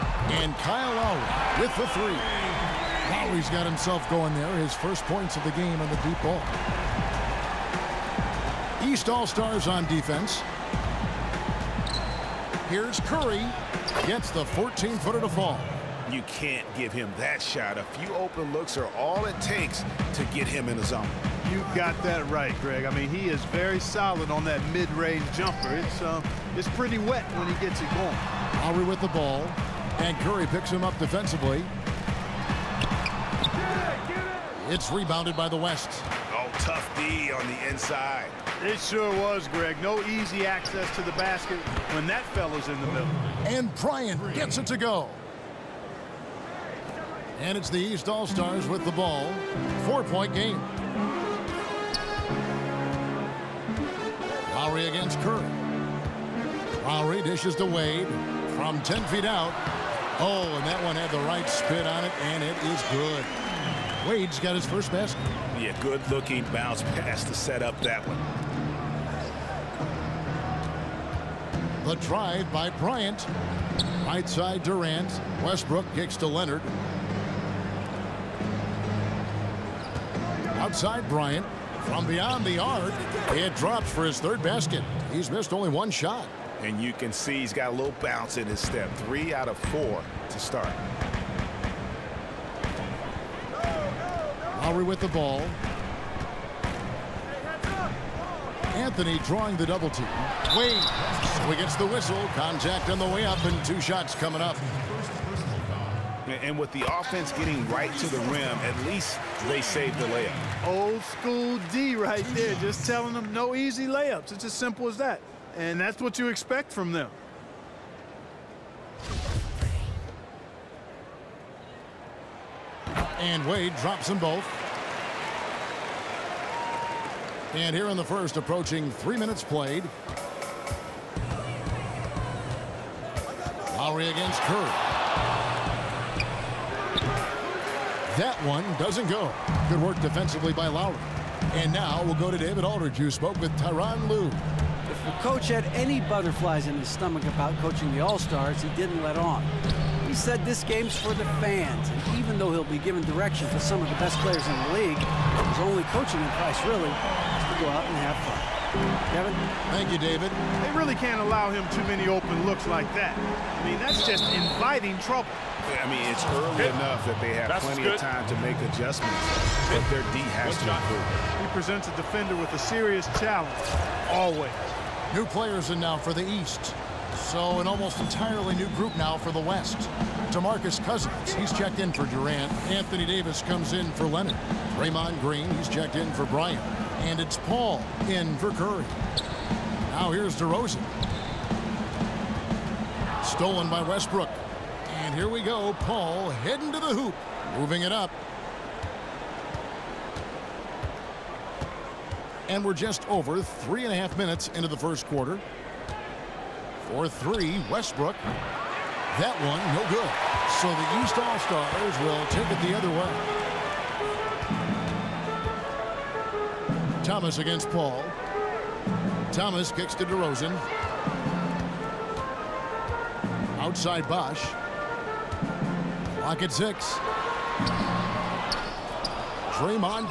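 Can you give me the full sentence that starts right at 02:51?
He presents a defender with a serious challenge, always.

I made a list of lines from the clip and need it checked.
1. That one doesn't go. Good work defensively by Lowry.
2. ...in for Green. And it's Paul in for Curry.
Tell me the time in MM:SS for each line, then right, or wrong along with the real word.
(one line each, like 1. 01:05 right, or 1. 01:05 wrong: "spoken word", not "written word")
1. 02:18 right
2. 03:05 wrong: "Bryant", not "Green".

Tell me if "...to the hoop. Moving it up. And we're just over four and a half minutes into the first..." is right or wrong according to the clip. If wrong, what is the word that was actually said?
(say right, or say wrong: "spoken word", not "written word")
wrong: "three", not "four".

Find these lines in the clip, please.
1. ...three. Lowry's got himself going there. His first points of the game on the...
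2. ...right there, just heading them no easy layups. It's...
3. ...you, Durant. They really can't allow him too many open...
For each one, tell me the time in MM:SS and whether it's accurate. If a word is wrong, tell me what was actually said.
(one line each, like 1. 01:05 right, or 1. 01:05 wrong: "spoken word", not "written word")
1. 00:01 right
2. 01:51 wrong: "telling", not "heading"
3. 02:39 wrong: "David", not "Durant".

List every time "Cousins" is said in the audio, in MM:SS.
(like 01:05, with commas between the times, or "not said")
03:00.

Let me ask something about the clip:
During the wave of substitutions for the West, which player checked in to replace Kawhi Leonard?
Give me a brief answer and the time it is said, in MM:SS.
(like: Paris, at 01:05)
Anthony Davis, at 03:02.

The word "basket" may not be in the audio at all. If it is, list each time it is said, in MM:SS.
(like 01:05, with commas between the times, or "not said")
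00:41, 01:04, 01:24.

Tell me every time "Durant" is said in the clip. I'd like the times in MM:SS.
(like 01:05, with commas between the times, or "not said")
01:14, 03:02.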